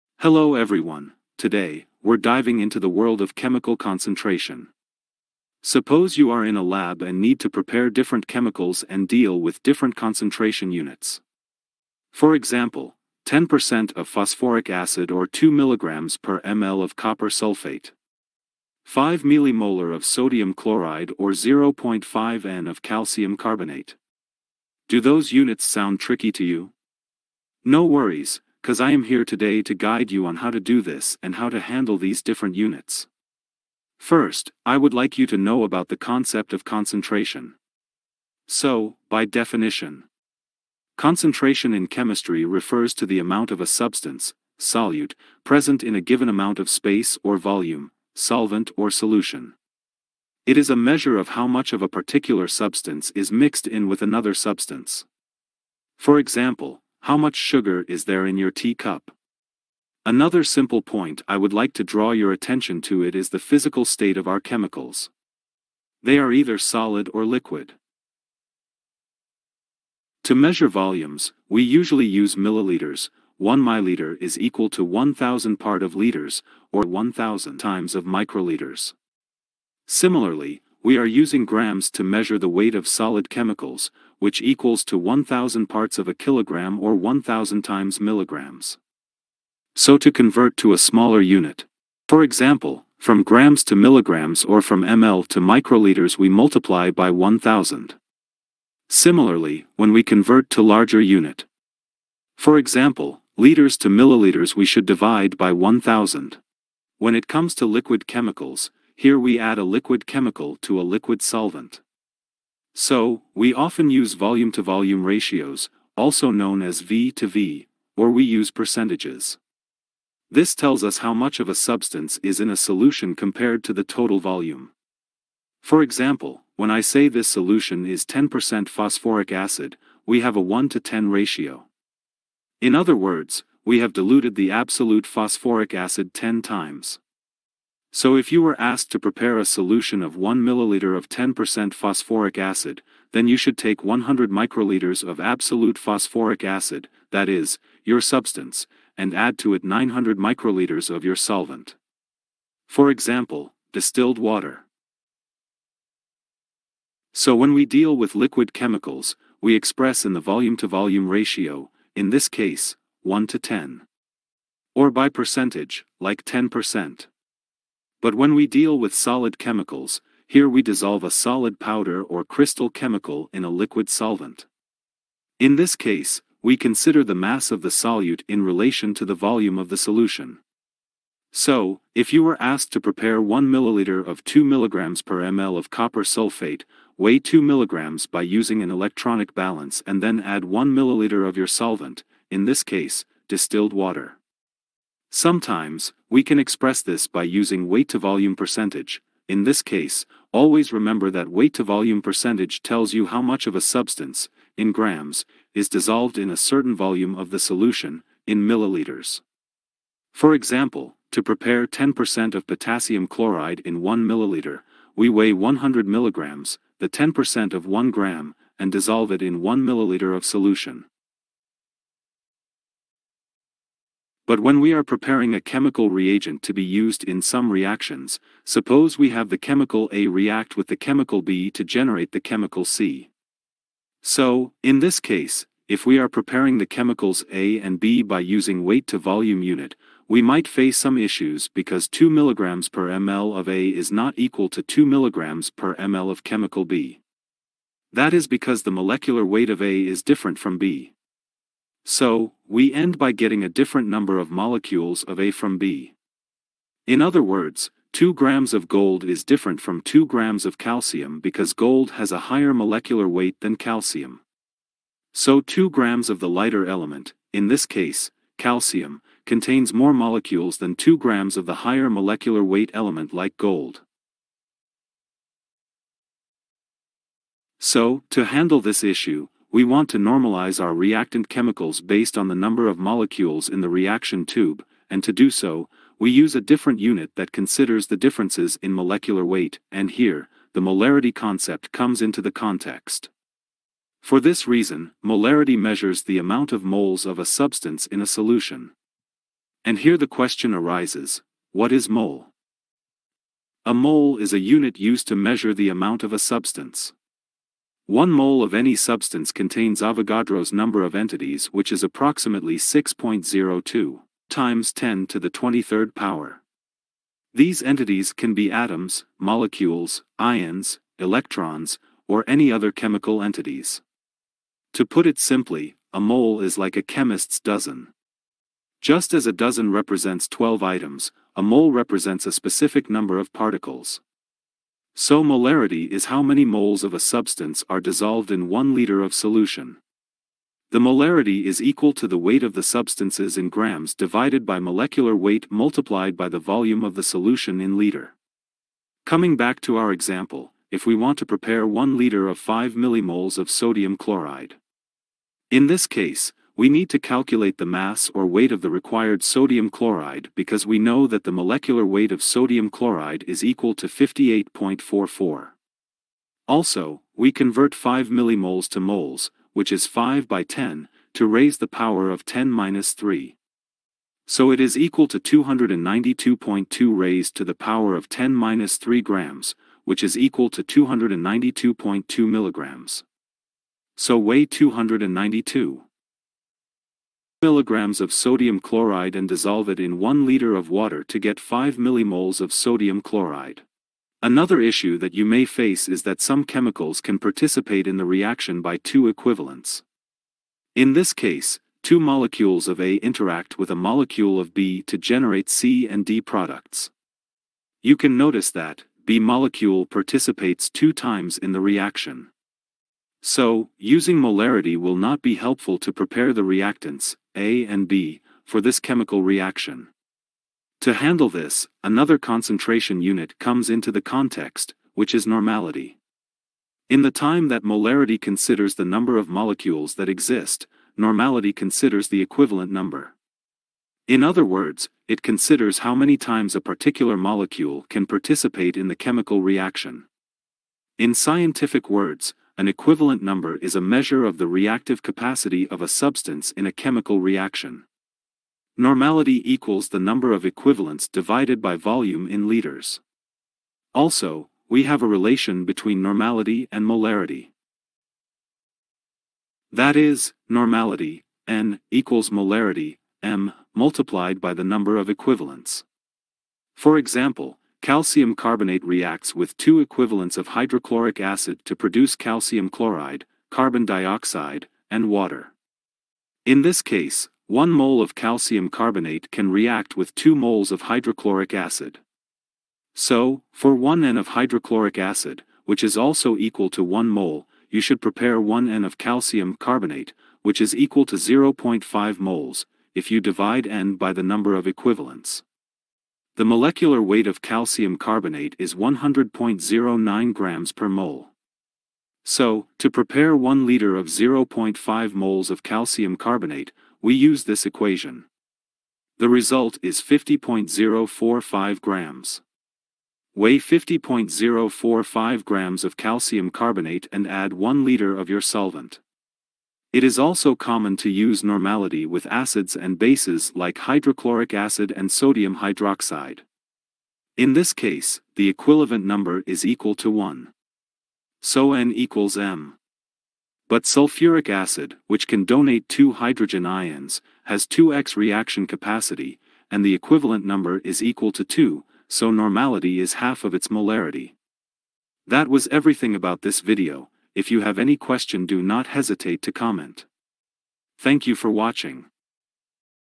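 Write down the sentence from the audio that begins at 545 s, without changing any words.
That was everything about this video, if you have any question do not hesitate to comment.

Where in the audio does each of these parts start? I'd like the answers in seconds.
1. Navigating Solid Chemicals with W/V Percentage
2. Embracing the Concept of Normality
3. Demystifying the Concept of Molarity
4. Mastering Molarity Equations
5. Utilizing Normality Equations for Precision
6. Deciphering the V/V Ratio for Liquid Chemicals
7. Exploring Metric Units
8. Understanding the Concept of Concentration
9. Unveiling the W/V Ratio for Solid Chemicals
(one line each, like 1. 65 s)
1. 198 s
2. 394 s
3. 224 s
4. 328 s
5. 448 s
6. 107 s
7. 69 s
8. 33 s
9. 167 s.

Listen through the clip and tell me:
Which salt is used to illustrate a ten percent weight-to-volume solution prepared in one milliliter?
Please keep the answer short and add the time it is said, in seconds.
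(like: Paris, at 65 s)
potassium chloride, at 212 s.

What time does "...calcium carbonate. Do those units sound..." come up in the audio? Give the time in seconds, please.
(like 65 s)
22 s.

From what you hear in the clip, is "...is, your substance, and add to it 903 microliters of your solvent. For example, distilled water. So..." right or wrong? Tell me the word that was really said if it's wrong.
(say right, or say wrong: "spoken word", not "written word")
wrong: "900", not "903".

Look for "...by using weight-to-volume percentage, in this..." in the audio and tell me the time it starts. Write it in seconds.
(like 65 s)
197 s.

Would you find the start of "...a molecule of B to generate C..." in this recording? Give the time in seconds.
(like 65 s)
403 s.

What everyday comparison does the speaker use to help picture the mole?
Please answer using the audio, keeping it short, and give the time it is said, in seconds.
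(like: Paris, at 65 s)
a chemist's dozen, at 326 s.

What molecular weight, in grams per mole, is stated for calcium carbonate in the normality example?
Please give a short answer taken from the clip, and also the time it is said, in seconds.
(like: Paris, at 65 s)
100.09, at 498 s.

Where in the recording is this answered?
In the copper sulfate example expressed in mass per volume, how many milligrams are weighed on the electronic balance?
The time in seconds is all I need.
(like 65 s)
186 s.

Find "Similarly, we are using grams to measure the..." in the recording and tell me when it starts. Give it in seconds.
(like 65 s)
79 s.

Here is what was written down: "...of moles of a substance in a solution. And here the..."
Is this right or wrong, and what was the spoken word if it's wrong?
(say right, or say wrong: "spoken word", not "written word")
right.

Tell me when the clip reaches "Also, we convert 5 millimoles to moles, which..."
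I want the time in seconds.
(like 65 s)
366 s.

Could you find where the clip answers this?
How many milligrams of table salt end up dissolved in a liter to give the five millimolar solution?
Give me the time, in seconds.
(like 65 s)
380 s.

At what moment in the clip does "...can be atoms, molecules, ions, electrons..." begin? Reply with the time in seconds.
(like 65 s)
318 s.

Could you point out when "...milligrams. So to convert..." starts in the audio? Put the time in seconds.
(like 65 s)
88 s.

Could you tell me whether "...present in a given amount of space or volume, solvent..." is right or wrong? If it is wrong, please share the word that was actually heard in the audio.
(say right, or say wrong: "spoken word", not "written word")
right.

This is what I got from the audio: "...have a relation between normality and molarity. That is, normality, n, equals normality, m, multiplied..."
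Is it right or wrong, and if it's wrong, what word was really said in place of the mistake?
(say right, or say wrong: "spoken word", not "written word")
wrong: "molarity", not "normality".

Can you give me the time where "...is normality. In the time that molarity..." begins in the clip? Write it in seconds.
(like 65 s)
425 s.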